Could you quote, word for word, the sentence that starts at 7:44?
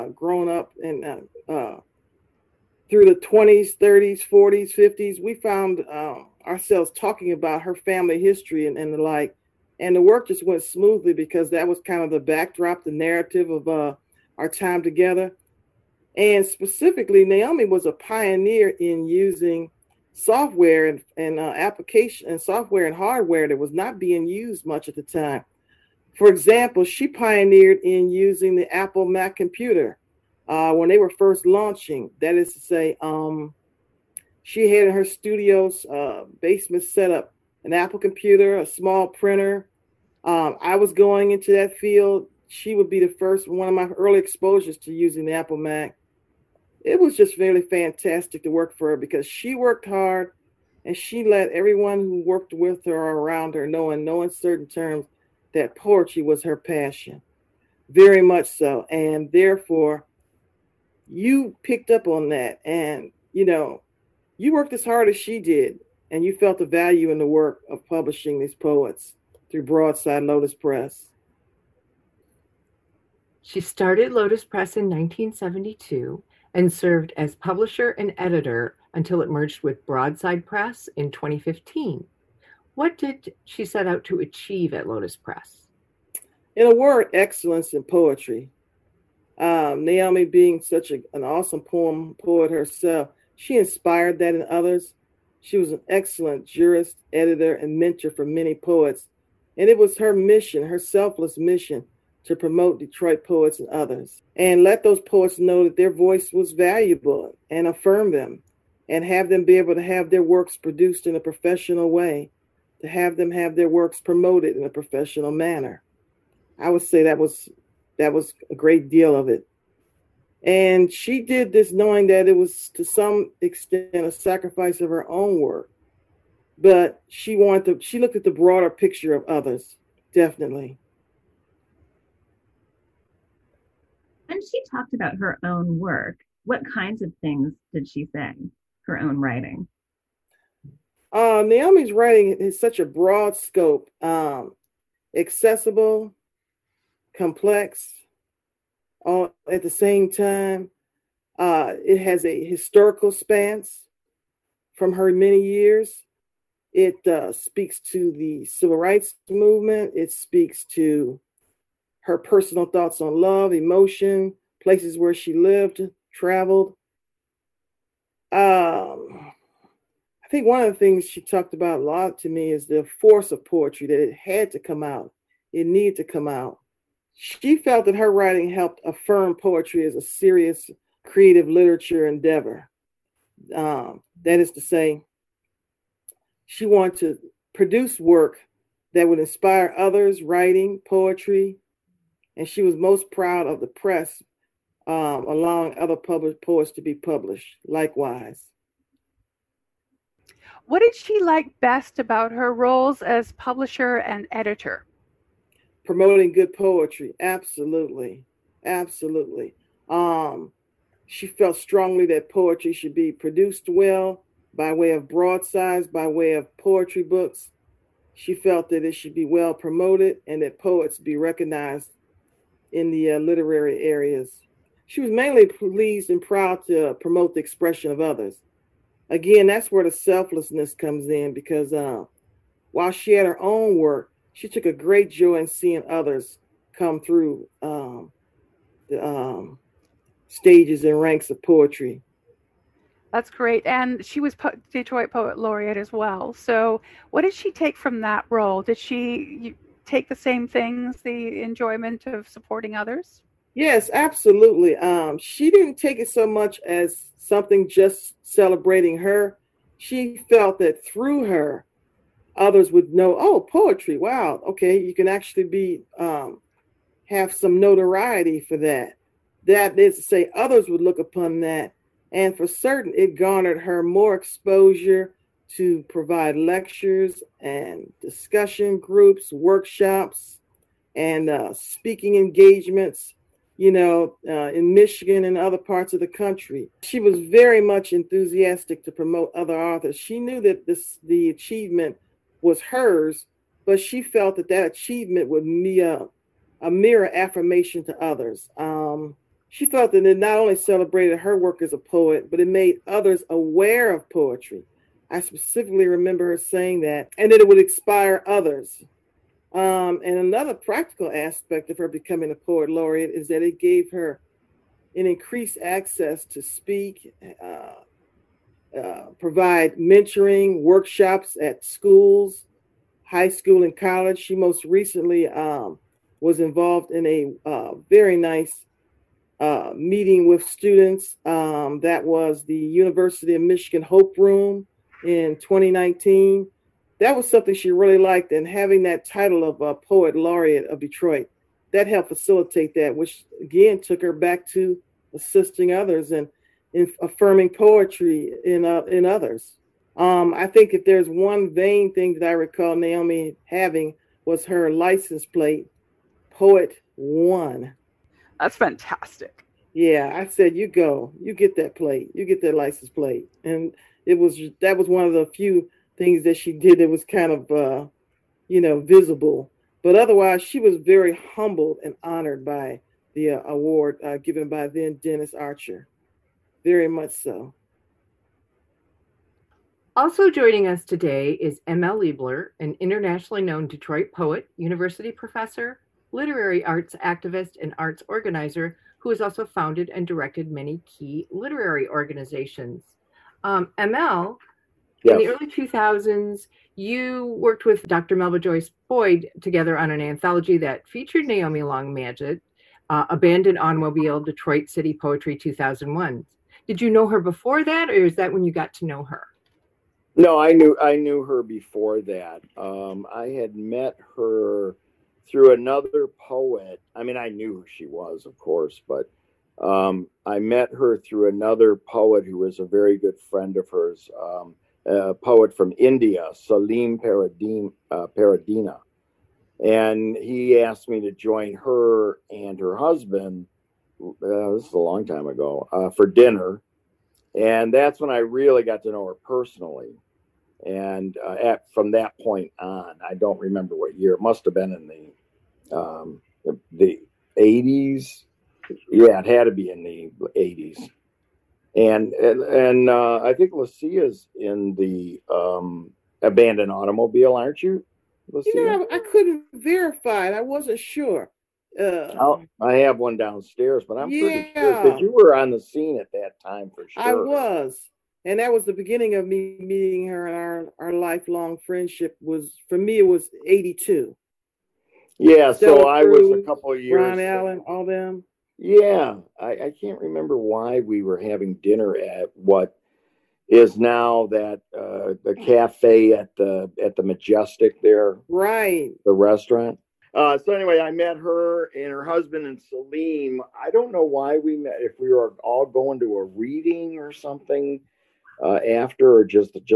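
pretty sure that you were on the scene at that time for sure.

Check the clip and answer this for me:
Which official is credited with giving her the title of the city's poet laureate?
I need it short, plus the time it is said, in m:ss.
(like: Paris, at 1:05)
Dennis Archer, at 6:15.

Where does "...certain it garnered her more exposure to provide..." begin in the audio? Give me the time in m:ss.
4:32.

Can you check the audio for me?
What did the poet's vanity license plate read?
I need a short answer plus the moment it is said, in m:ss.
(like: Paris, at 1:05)
Poet One, at 5:56.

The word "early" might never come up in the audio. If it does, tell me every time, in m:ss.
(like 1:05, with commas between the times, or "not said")
0:43, 6:35.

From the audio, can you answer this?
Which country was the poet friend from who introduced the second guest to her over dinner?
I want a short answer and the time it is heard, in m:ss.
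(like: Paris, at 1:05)
India, at 7:05.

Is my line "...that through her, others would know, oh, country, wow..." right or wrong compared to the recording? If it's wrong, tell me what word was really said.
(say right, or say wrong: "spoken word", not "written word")
wrong: "poetry", not "country".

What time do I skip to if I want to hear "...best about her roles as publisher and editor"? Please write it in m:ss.
3:21.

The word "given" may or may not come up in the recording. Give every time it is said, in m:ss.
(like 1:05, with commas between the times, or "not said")
6:14.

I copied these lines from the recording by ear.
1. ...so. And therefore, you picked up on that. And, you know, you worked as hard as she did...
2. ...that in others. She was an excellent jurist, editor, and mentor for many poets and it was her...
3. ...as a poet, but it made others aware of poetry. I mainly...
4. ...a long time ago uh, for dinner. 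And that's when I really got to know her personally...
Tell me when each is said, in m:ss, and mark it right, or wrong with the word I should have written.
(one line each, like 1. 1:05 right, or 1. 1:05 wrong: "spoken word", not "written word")
1. 0:58 right
2. 1:34 right
3. 5:01 wrong: "specifically", not "mainly"
4. 7:14 right.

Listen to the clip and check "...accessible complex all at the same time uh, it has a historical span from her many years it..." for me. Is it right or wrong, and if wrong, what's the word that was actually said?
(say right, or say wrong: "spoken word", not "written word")
right.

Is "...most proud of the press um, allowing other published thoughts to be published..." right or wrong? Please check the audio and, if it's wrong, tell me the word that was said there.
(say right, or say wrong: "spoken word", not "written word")
wrong: "poets", not "thoughts".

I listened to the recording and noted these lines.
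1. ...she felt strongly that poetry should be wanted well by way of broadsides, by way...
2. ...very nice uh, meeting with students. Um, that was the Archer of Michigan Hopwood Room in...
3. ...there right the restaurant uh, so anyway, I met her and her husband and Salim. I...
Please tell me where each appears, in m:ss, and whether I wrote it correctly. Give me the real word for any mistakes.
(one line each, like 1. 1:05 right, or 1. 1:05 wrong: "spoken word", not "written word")
1. 3:31 wrong: "produced", not "wanted"
2. 5:27 wrong: "University", not "Archer"
3. 8:07 right.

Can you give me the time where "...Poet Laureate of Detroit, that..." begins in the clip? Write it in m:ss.
5:39.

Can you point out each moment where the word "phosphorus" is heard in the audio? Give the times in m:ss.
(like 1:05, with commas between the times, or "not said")
not said.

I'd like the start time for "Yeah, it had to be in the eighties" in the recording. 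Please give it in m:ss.
7:28.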